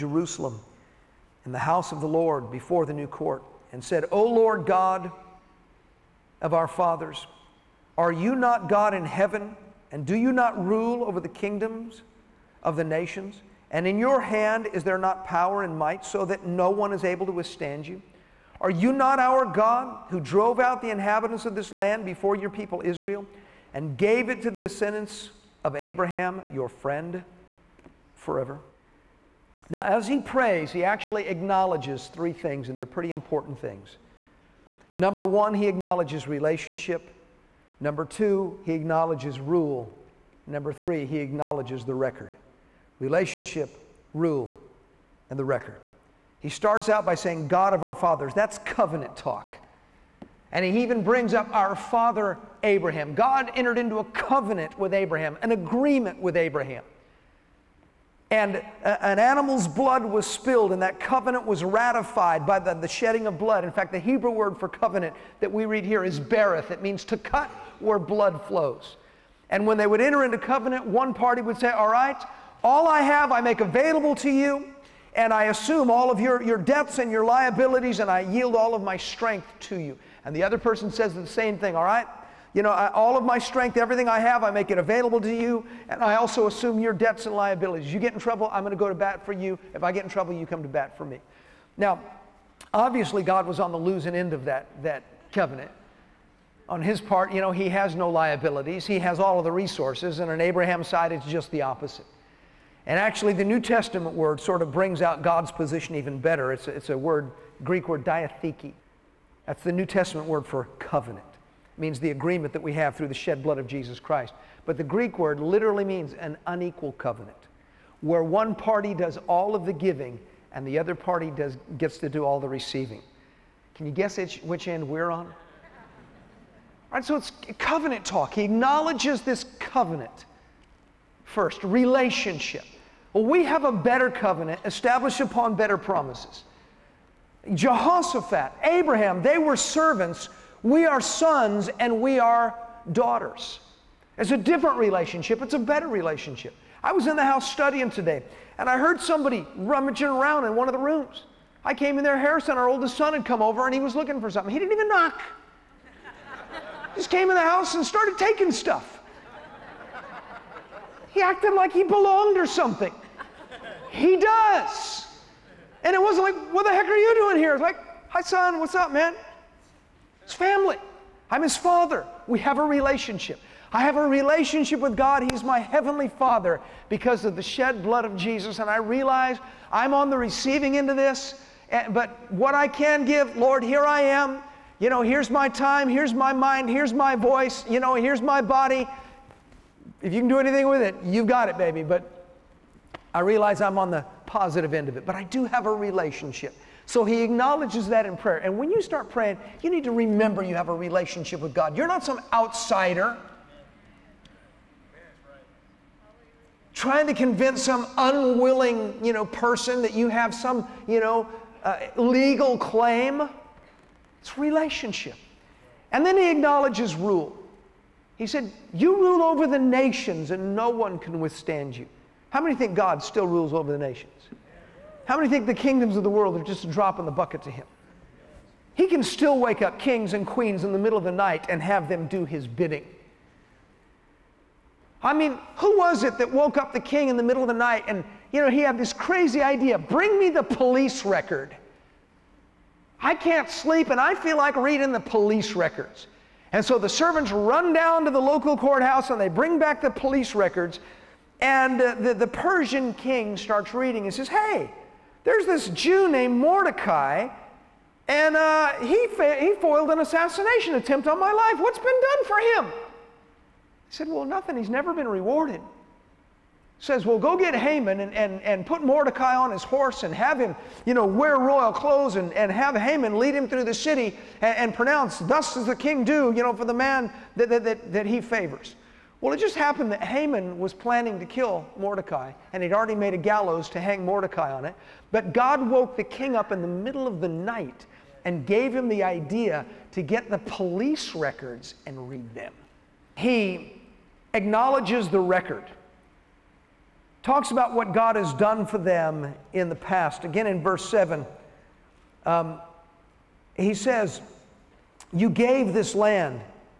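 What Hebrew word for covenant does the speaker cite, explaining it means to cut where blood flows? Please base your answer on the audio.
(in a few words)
bereth.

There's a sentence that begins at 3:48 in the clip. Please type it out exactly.
He can still wake up kings and queens in the middle of the night and have them do his bidding.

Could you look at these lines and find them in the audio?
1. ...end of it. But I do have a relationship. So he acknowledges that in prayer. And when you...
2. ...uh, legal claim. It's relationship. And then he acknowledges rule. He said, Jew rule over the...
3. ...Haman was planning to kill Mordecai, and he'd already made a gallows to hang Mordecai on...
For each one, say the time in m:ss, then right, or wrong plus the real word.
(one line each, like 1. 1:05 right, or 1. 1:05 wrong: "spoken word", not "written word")
1. 3:14 right
2. 3:31 wrong: "You", not "Jew"
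3. 4:40 right.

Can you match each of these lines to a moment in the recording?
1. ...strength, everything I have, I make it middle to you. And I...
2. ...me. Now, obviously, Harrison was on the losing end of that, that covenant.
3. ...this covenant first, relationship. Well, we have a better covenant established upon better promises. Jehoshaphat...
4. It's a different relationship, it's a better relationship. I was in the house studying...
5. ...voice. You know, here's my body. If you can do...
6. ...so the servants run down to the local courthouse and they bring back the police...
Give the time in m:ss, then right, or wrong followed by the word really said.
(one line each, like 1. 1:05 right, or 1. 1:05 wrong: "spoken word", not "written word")
1. 1:23 wrong: "available", not "middle"
2. 1:31 wrong: "God", not "Harrison"
3. 2:09 right
4. 2:24 right
5. 3:07 right
6. 4:06 right.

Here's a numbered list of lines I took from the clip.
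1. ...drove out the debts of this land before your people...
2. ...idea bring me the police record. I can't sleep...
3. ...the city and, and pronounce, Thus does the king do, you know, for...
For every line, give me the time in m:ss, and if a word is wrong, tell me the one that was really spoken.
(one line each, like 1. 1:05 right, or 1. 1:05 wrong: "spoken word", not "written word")
1. 0:20 wrong: "inhabitants", not "debts"
2. 3:59 right
3. 4:33 right.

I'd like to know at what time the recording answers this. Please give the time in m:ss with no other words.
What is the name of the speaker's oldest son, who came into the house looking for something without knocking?
2:32.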